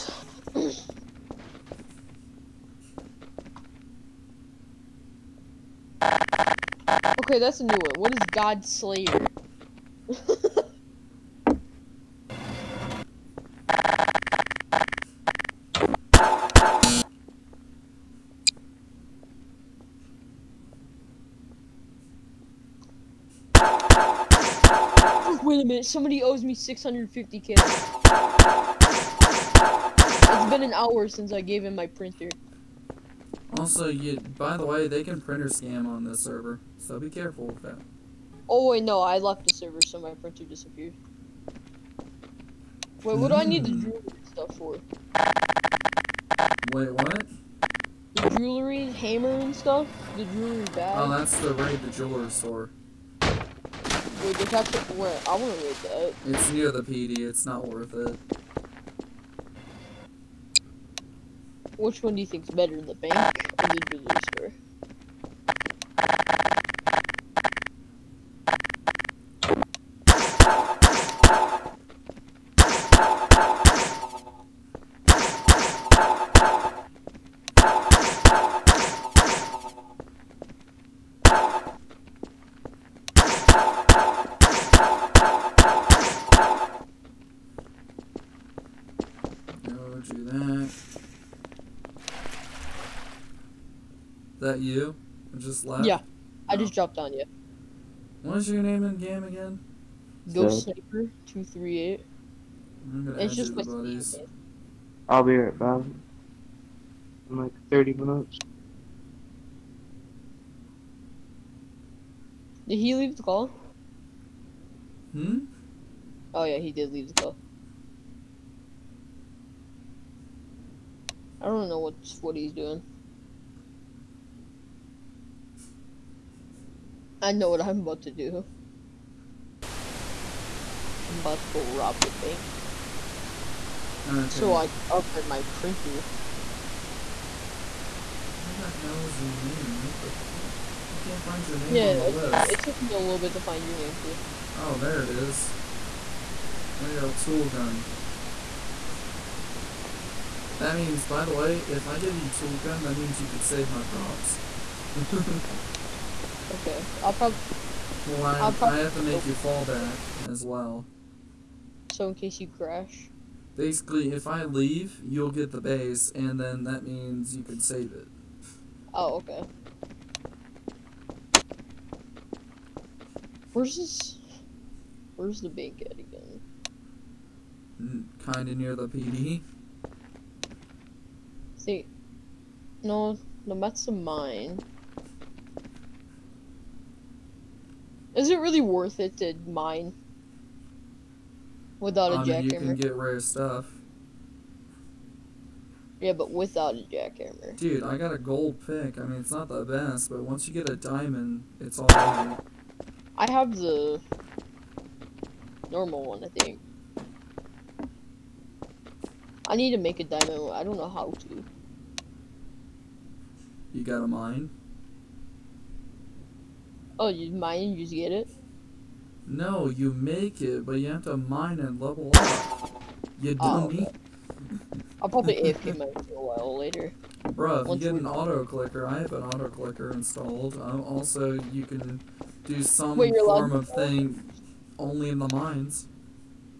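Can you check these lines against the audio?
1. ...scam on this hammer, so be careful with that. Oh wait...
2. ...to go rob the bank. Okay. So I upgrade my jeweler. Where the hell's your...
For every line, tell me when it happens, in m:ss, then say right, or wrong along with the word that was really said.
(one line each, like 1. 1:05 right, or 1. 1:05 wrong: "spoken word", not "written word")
1. 0:35 wrong: "server", not "hammer"
2. 2:11 wrong: "printer", not "jeweler".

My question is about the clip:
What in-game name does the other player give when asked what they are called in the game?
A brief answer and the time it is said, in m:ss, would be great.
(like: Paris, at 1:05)
Ghost Sniper 238, at 1:40.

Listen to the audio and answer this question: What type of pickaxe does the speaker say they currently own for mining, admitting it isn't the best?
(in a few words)
gold pick.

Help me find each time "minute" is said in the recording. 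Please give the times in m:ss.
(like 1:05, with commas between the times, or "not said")
0:25, 1:47.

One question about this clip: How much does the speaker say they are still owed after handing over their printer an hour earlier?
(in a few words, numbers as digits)
650k.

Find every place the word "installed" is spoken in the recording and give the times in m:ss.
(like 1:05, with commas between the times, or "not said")
3:49.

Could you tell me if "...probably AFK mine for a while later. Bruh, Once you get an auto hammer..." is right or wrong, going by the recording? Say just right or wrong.
wrong.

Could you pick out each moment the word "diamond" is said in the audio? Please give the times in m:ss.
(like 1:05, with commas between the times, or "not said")
3:20, 3:30.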